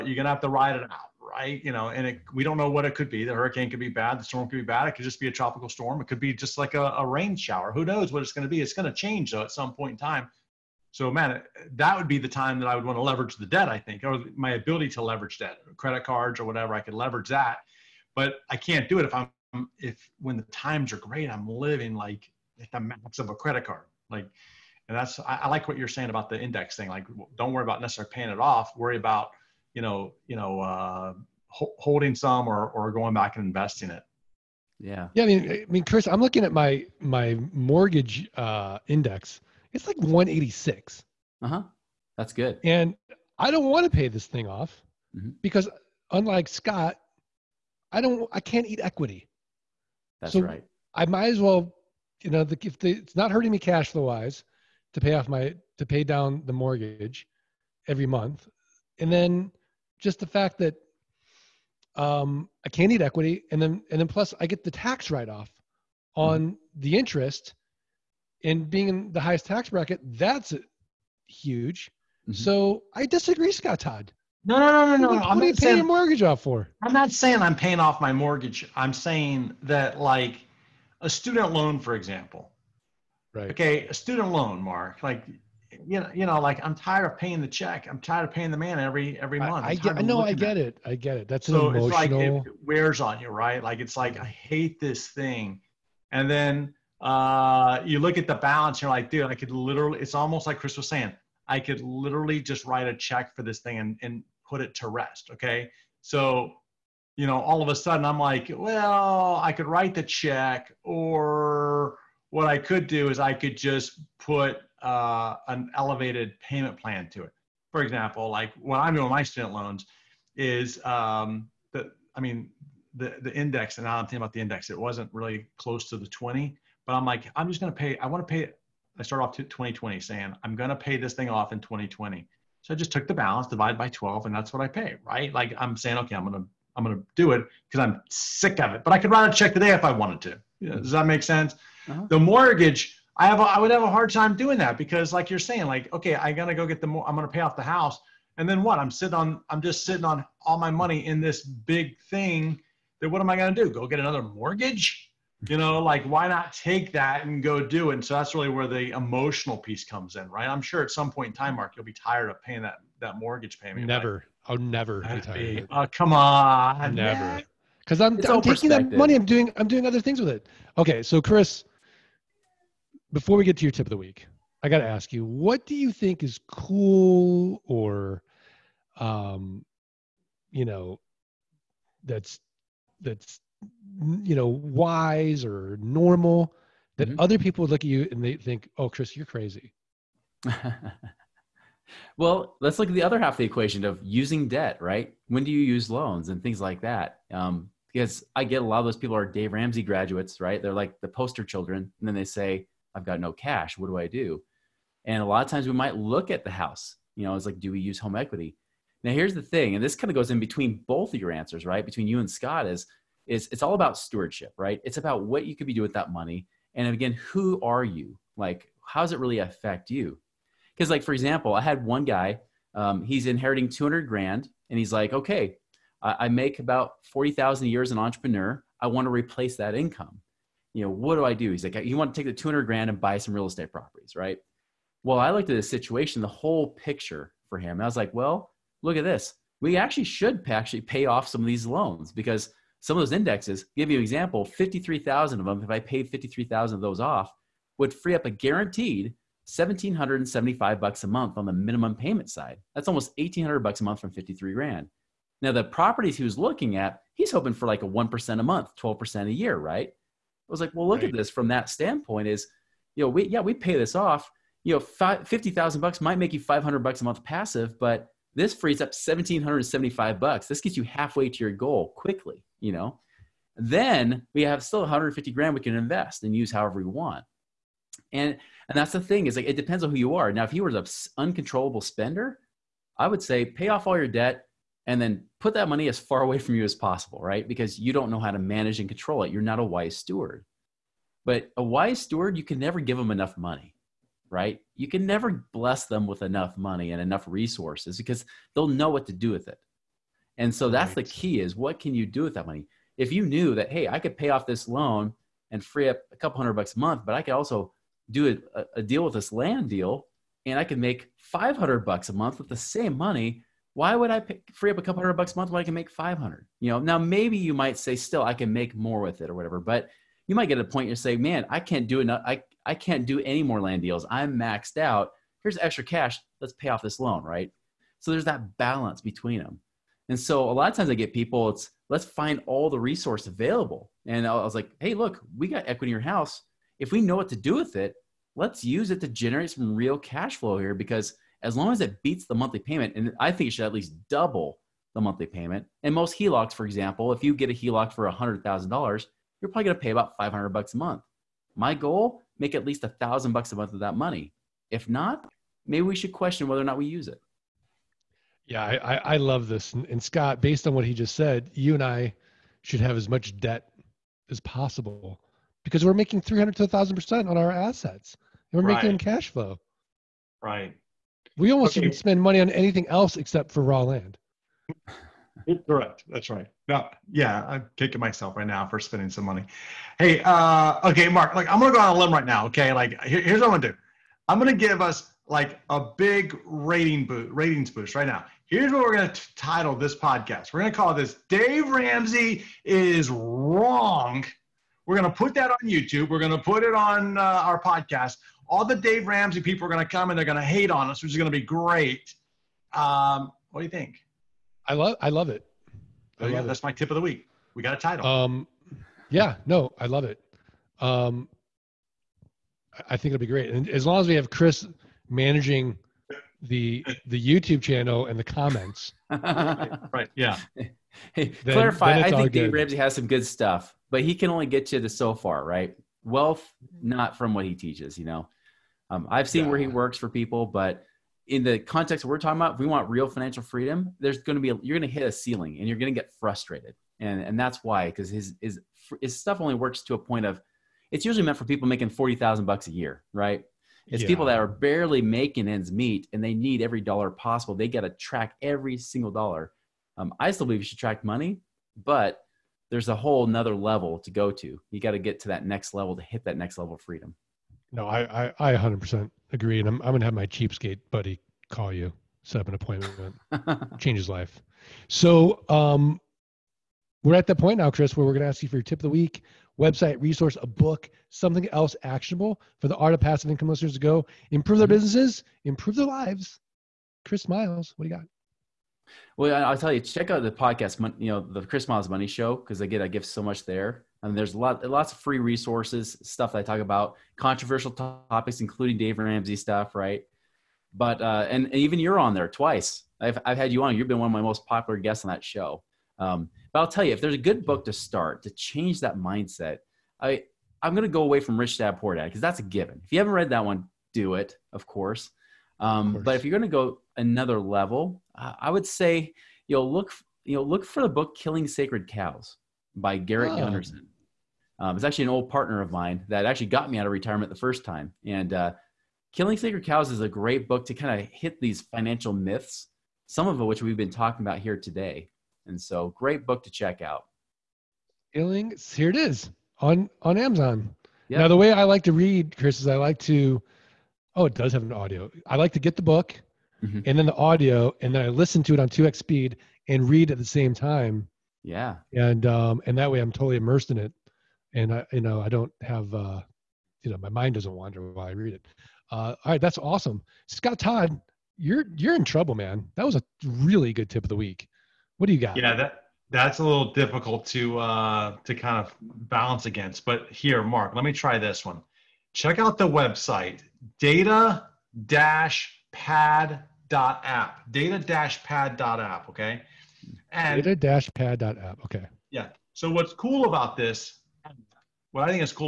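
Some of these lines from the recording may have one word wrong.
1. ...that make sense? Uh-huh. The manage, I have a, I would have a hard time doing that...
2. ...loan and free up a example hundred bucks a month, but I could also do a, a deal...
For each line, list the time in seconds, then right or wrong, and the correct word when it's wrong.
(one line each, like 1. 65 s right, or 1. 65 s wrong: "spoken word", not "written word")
1. 140 s wrong: "mortgage", not "manage"
2. 304 s wrong: "couple", not "example".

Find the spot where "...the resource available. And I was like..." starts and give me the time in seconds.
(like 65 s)
332 s.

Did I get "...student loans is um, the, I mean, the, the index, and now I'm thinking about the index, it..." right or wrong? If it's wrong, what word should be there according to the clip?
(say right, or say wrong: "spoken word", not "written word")
right.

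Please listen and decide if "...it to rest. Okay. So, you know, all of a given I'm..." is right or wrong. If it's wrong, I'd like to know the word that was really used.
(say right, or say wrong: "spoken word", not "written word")
wrong: "sudden", not "given".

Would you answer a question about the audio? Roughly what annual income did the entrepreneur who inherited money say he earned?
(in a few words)
$40,000.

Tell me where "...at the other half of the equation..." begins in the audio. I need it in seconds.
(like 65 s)
192 s.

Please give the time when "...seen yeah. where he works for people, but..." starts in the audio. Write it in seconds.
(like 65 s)
429 s.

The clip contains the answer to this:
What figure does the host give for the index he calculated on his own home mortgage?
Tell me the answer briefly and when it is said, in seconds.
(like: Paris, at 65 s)
186, at 39 s.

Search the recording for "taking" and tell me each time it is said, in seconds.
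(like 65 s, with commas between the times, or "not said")
168 s.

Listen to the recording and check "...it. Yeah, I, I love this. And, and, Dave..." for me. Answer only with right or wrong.
wrong.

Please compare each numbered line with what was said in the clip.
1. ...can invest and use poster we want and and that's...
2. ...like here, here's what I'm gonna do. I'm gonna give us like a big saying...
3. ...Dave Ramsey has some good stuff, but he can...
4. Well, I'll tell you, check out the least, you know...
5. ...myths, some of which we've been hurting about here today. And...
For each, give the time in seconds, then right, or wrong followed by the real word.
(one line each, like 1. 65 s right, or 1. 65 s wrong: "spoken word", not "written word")
1. 275 s wrong: "however", not "poster"
2. 382 s wrong: "rating", not "saying"
3. 422 s right
4. 479 s wrong: "podcast", not "least"
5. 522 s wrong: "talking", not "hurting".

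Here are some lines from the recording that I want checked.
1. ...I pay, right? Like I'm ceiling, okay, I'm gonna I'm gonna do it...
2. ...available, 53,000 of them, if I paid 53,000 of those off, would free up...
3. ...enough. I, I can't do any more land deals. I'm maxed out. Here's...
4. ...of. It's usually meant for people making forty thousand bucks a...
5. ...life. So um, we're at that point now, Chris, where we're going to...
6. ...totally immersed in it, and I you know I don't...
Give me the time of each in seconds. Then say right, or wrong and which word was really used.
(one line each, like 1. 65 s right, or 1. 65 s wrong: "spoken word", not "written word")
1. 134 s wrong: "saying", not "ceiling"
2. 244 s wrong: "example", not "available"
3. 321 s right
4. 440 s right
5. 464 s right
6. 543 s right.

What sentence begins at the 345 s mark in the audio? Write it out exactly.
And most HELOCs, for example, if you get a HELOC for $100,000, you're probably going to pay about 500 bucks a month.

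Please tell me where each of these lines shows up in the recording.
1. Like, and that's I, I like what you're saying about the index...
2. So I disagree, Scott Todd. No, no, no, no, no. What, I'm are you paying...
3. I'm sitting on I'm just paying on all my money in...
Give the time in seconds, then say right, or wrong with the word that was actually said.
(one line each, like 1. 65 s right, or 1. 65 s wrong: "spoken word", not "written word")
1. 24 s right
2. 72 s right
3. 148 s wrong: "sitting", not "paying".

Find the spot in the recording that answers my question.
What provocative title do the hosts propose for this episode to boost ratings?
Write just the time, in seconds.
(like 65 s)
391 s.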